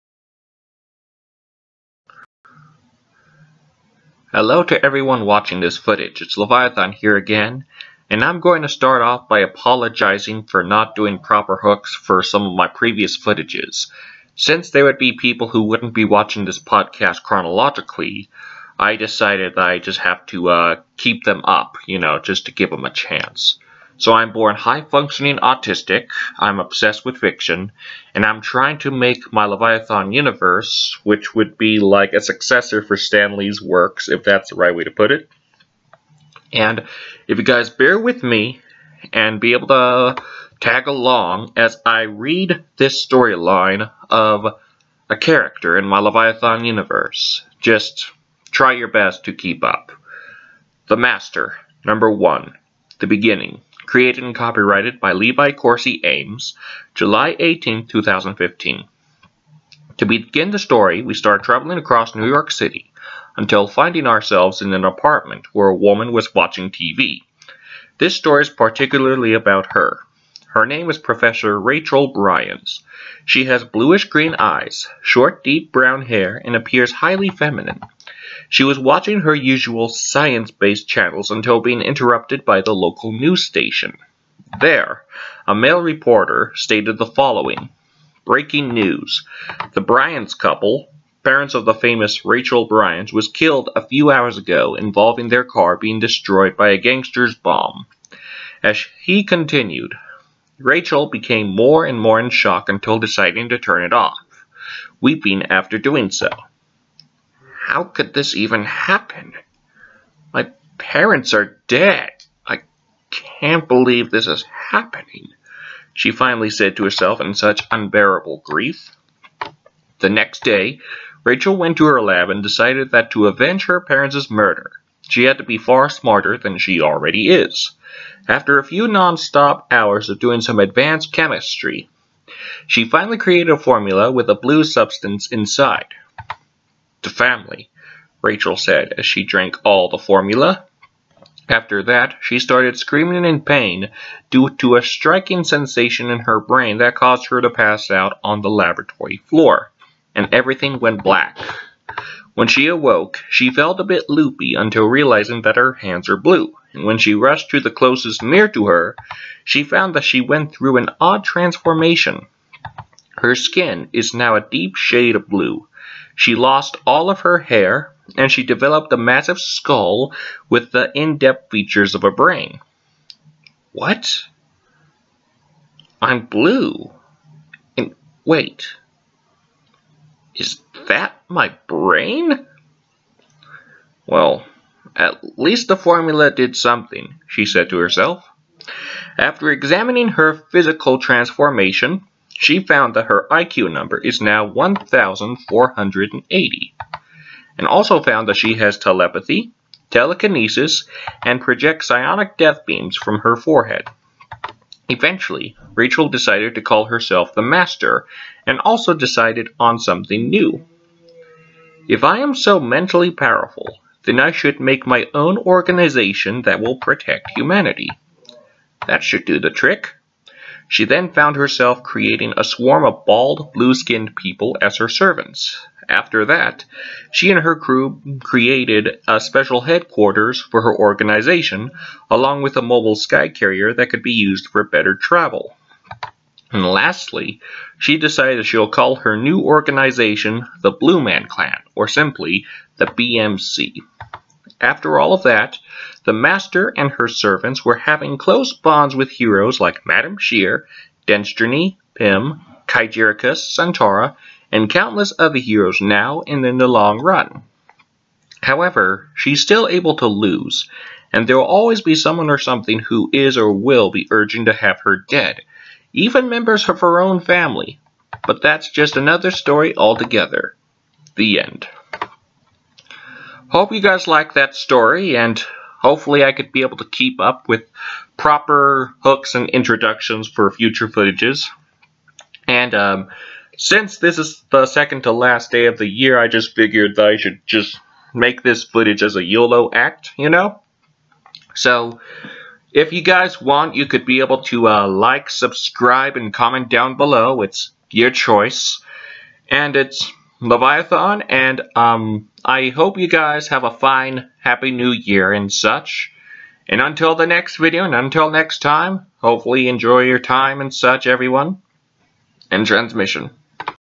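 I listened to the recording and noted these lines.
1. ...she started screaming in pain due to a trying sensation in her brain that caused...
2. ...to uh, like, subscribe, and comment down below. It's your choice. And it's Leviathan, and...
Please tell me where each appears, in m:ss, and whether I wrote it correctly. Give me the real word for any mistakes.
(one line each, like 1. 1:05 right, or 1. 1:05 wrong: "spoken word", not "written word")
1. 2:22 wrong: "striking", not "trying"
2. 4:54 right.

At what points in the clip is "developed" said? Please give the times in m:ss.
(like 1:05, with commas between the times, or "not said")
2:48.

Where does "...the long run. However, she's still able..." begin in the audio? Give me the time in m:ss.
4:16.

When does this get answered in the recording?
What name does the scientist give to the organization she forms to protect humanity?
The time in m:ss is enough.
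4:00.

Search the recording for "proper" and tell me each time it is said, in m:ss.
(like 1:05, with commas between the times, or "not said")
0:11, 4:38.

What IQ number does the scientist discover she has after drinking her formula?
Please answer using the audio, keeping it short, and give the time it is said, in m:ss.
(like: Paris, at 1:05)
1480, at 3:14.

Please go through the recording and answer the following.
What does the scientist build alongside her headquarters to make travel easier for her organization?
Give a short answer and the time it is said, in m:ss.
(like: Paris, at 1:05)
mobile sky carrier, at 3:52.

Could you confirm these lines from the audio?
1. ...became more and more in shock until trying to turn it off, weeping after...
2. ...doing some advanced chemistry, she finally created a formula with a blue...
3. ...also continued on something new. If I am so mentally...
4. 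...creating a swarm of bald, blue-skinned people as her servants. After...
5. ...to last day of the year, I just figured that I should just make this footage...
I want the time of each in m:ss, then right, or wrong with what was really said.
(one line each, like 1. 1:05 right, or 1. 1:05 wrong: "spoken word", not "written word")
1. 1:41 wrong: "deciding", not "trying"
2. 2:10 right
3. 3:28 wrong: "decided", not "continued"
4. 3:41 right
5. 4:45 right.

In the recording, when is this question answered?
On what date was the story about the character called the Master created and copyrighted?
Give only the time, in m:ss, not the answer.
0:56.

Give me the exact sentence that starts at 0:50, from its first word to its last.
The Master, number one, the beginning.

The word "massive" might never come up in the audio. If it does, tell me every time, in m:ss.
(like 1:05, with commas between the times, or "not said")
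2:48.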